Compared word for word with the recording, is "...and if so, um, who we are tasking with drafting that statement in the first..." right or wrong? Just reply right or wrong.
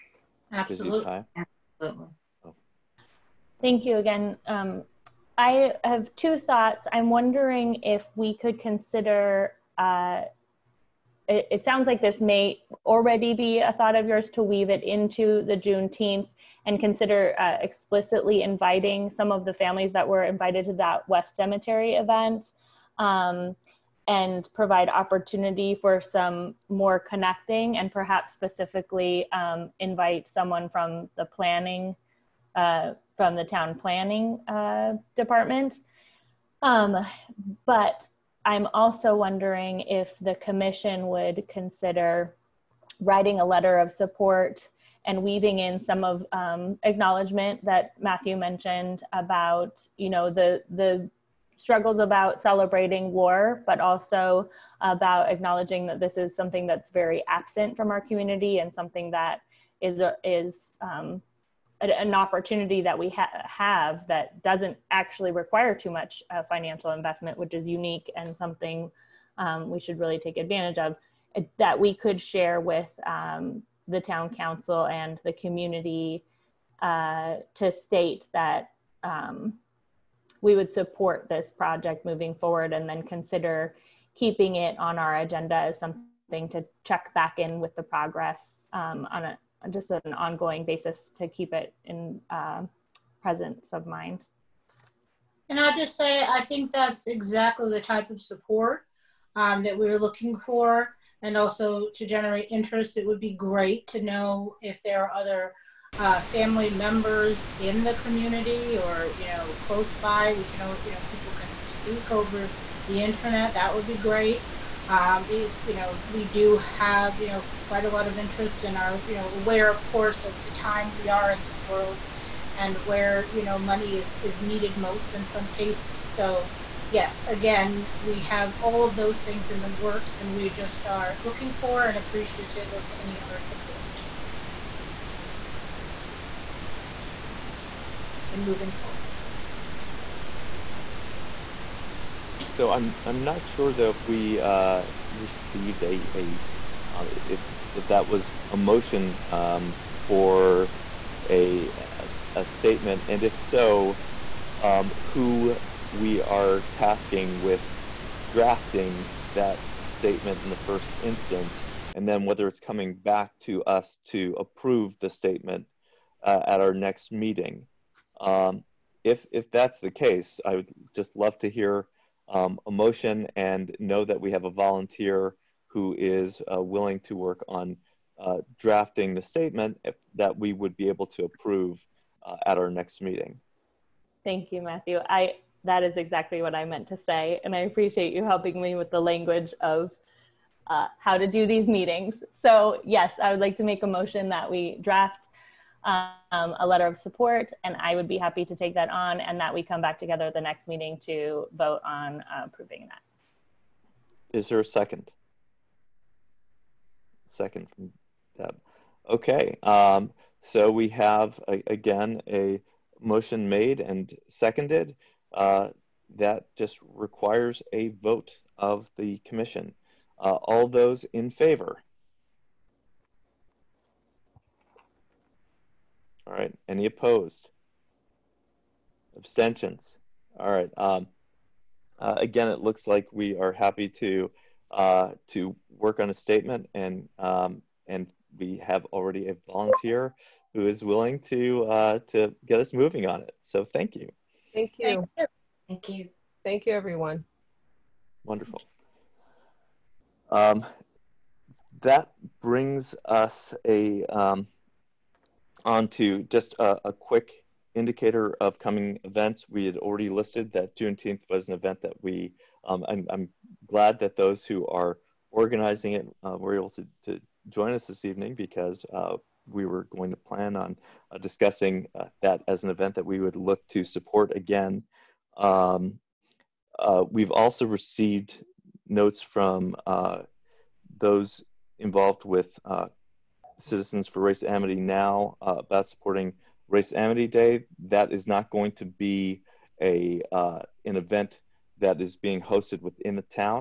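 right.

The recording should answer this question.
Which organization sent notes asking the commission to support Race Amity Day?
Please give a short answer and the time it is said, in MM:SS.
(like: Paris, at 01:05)
Citizens for Race Amity Now, at 04:43.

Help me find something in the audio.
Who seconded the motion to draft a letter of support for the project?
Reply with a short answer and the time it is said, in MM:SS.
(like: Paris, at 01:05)
Deb, at 03:28.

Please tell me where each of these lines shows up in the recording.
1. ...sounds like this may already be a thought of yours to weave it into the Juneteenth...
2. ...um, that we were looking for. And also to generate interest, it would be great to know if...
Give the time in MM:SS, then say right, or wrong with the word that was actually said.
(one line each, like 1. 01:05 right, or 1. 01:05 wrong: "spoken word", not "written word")
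1. 00:11 right
2. 01:39 right.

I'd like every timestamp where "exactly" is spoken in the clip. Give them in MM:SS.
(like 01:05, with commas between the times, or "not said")
01:37, 03:05.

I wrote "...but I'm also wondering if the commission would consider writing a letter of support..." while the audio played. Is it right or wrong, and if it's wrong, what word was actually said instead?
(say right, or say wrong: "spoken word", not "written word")
right.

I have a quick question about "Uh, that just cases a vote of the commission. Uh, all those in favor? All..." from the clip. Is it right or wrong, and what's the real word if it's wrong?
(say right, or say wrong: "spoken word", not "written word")
wrong: "requires", not "cases".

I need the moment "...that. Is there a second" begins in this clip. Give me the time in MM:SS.
03:22.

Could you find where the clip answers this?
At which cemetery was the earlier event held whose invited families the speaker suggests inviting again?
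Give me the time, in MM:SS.
00:21.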